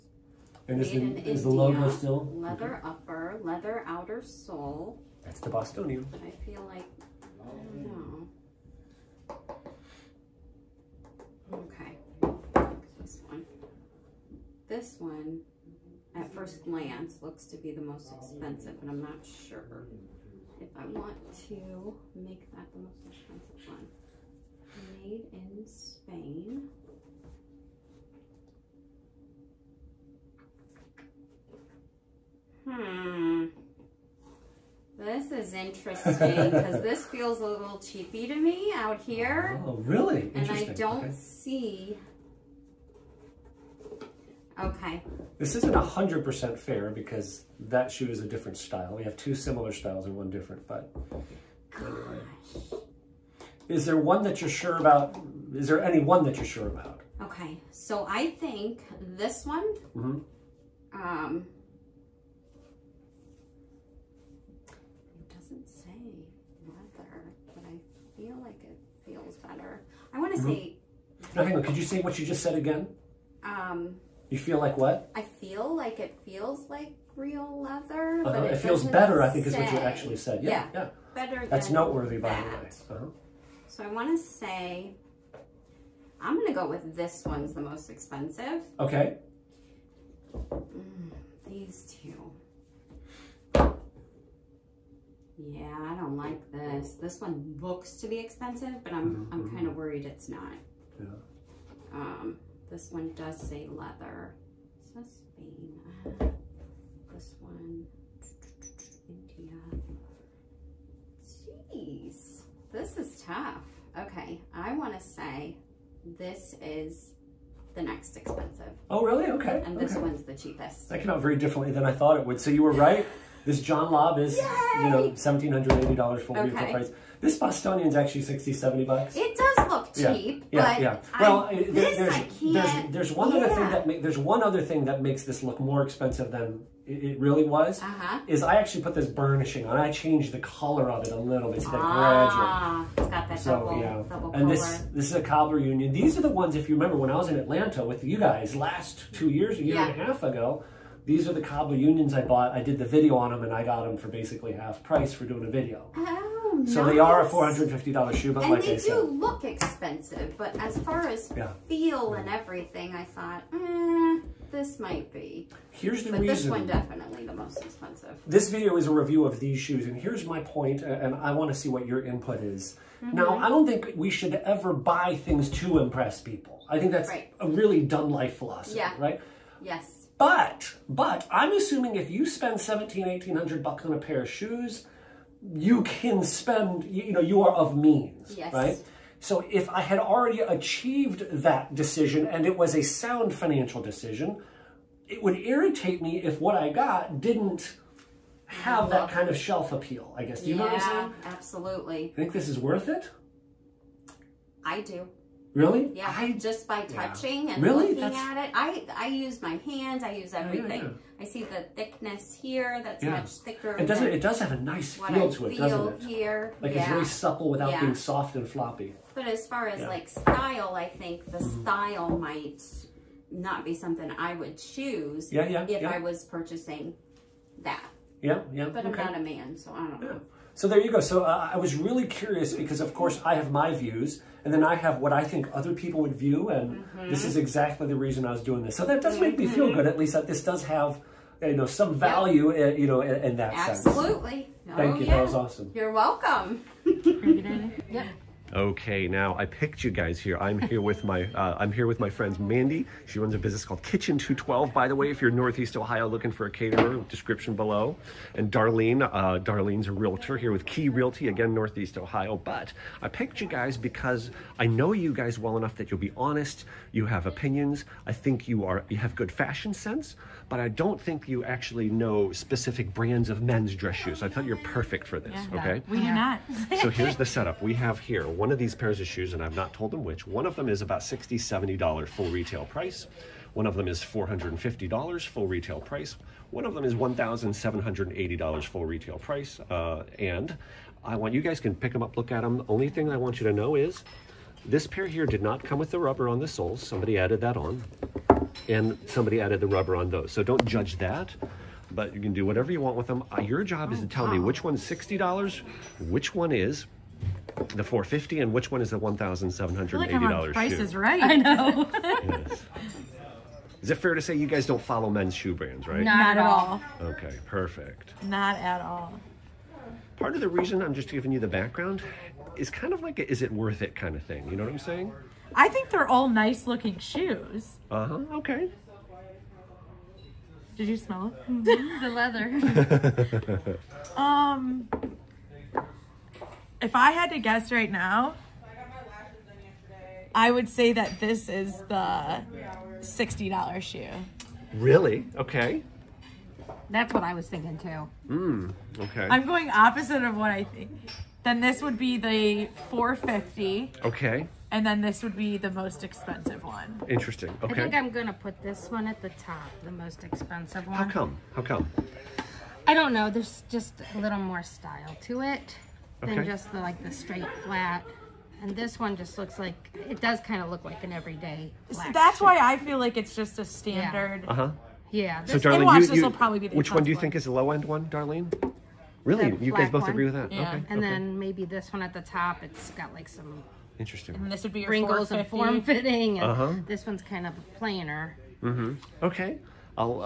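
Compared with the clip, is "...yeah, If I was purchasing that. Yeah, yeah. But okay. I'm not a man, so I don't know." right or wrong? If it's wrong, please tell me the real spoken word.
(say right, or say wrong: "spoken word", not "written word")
right.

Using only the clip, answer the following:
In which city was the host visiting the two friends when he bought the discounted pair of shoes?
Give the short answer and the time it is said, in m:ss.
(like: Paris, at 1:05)
Atlanta, at 2:27.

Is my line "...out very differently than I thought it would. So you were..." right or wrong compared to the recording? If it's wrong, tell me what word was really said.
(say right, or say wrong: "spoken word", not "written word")
right.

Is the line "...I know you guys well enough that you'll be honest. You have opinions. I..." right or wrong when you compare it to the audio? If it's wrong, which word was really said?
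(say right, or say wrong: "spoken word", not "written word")
right.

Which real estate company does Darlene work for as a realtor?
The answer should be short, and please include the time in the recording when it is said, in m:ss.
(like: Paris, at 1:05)
Key Realty, at 4:20.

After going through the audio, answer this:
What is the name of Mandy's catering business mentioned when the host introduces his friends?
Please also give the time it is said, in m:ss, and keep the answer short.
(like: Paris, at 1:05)
Kitchen 212, at 4:13.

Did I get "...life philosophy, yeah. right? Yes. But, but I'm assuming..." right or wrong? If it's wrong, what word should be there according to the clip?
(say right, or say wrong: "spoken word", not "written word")
right.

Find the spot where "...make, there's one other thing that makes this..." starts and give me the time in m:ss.
2:13.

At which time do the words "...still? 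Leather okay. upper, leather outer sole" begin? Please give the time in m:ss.
0:01.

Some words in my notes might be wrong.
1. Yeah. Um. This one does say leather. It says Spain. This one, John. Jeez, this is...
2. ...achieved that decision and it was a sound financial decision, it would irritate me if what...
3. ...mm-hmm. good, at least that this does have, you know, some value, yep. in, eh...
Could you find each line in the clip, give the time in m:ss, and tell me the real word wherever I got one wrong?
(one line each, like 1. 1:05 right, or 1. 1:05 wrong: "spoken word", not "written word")
1. 1:40 wrong: "India", not "John"
2. 3:10 right
3. 3:59 right.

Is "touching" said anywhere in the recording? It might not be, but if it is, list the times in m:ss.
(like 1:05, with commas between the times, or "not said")
3:26.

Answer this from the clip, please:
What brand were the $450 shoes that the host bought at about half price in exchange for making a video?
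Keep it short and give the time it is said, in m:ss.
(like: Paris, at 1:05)
Cobbler Union, at 2:25.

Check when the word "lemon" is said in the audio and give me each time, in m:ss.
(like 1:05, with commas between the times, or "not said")
not said.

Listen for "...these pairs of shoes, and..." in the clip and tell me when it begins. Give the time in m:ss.
4:38.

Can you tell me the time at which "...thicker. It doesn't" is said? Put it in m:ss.
3:33.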